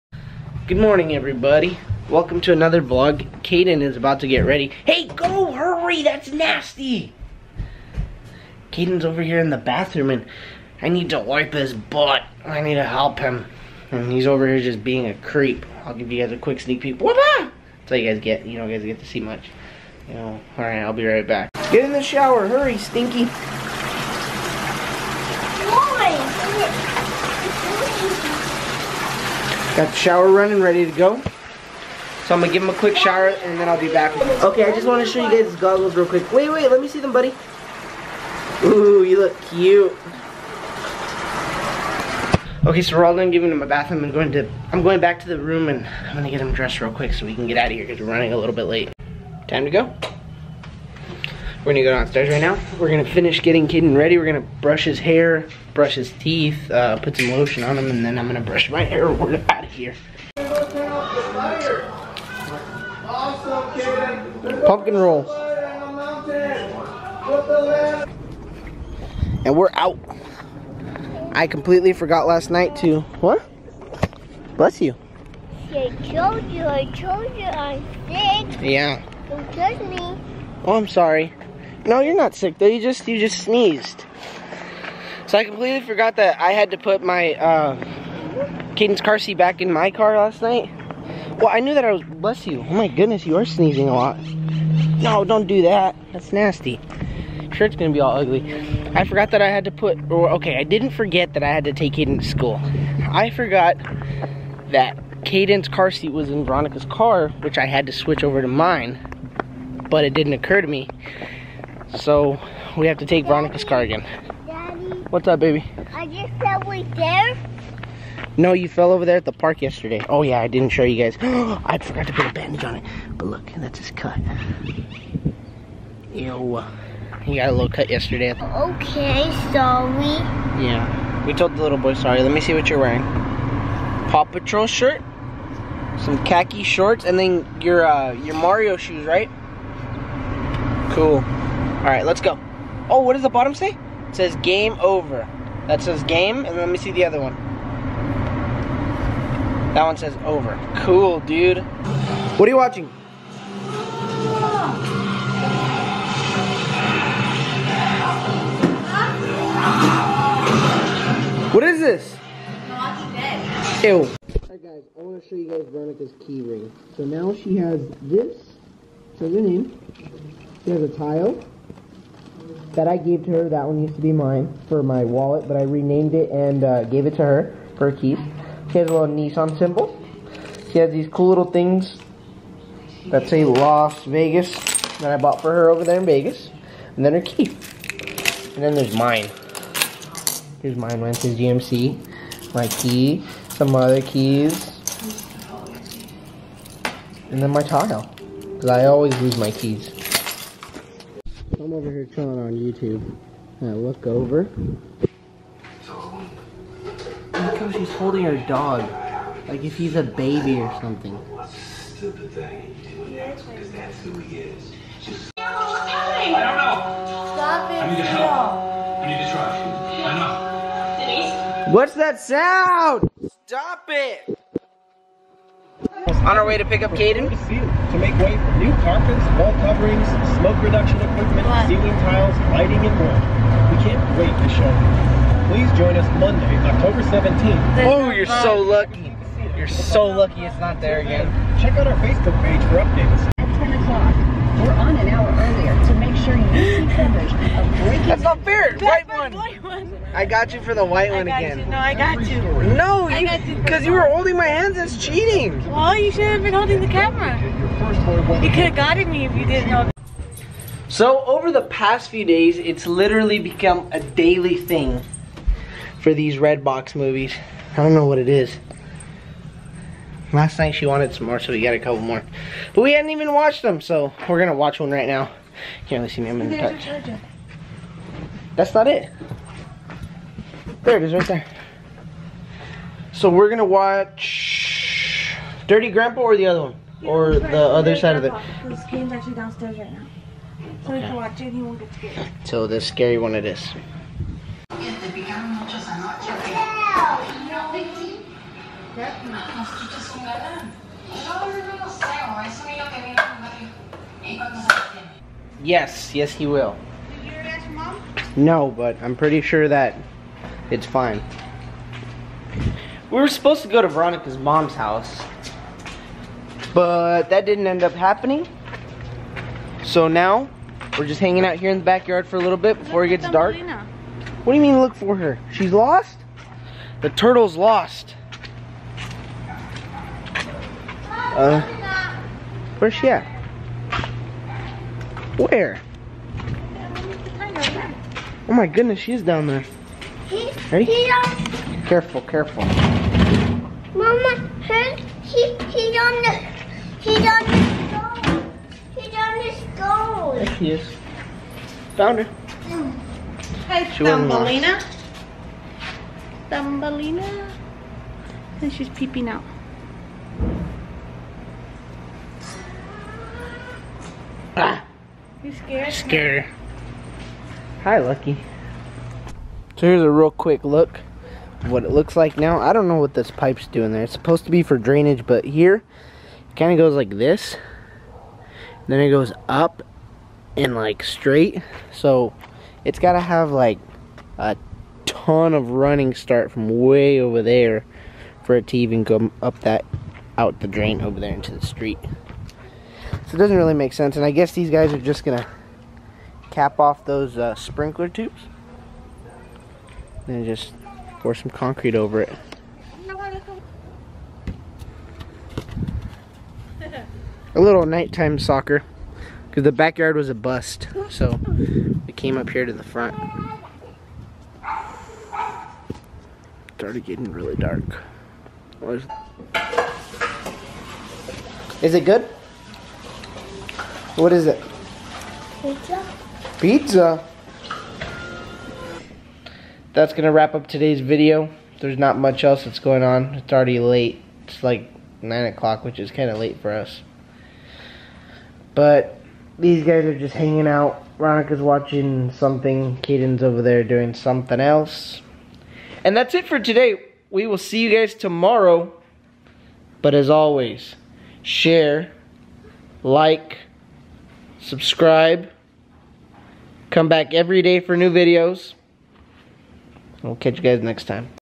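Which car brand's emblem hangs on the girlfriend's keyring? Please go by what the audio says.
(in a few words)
Nissan.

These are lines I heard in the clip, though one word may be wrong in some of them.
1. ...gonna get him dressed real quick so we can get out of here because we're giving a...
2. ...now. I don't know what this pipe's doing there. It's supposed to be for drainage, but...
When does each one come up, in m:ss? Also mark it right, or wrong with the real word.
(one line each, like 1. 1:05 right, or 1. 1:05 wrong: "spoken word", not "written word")
1. 0:46 wrong: "running", not "giving"
2. 6:12 right.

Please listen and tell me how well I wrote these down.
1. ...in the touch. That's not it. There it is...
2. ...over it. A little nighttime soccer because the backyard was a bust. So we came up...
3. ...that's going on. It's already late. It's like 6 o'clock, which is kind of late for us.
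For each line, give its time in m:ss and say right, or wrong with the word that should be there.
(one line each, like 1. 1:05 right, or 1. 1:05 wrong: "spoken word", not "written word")
1. 4:36 right
2. 6:41 right
3. 7:12 wrong: "9", not "6".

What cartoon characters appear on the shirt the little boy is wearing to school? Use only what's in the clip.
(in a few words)
Paw Patrol.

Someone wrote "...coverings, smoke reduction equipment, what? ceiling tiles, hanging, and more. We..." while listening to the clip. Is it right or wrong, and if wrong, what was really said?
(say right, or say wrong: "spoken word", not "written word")
wrong: "lighting", not "hanging".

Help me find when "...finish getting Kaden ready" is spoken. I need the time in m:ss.
0:53.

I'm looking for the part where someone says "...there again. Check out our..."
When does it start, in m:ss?
4:00.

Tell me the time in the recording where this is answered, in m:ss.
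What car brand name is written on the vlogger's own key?
3:11.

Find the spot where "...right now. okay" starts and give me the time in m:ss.
4:49.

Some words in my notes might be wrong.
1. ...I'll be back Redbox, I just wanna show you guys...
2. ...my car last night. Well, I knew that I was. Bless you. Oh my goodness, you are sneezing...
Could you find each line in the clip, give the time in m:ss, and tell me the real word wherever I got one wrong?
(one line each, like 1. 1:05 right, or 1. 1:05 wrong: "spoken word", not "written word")
1. 0:33 wrong: "Okay", not "Redbox"
2. 1:29 right.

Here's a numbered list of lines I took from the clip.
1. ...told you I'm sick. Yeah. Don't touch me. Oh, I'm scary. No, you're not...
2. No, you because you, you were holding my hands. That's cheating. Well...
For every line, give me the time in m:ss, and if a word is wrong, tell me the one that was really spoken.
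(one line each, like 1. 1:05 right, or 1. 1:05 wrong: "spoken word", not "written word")
1. 1:16 wrong: "sorry", not "scary"
2. 4:12 right.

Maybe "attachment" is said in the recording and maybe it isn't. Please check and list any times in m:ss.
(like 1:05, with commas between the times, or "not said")
not said.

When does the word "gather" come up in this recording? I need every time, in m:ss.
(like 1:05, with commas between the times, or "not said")
not said.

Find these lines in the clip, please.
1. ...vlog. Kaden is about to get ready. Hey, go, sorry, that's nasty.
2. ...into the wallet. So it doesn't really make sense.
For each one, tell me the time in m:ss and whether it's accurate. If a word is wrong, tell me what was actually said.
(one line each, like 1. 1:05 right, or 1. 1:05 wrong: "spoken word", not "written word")
1. 0:02 wrong: "hurry", not "sorry"
2. 6:31 wrong: "street", not "wallet".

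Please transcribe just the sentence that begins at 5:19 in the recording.
So now we're just hanging out here in the backyard for a little bit before look it gets dark.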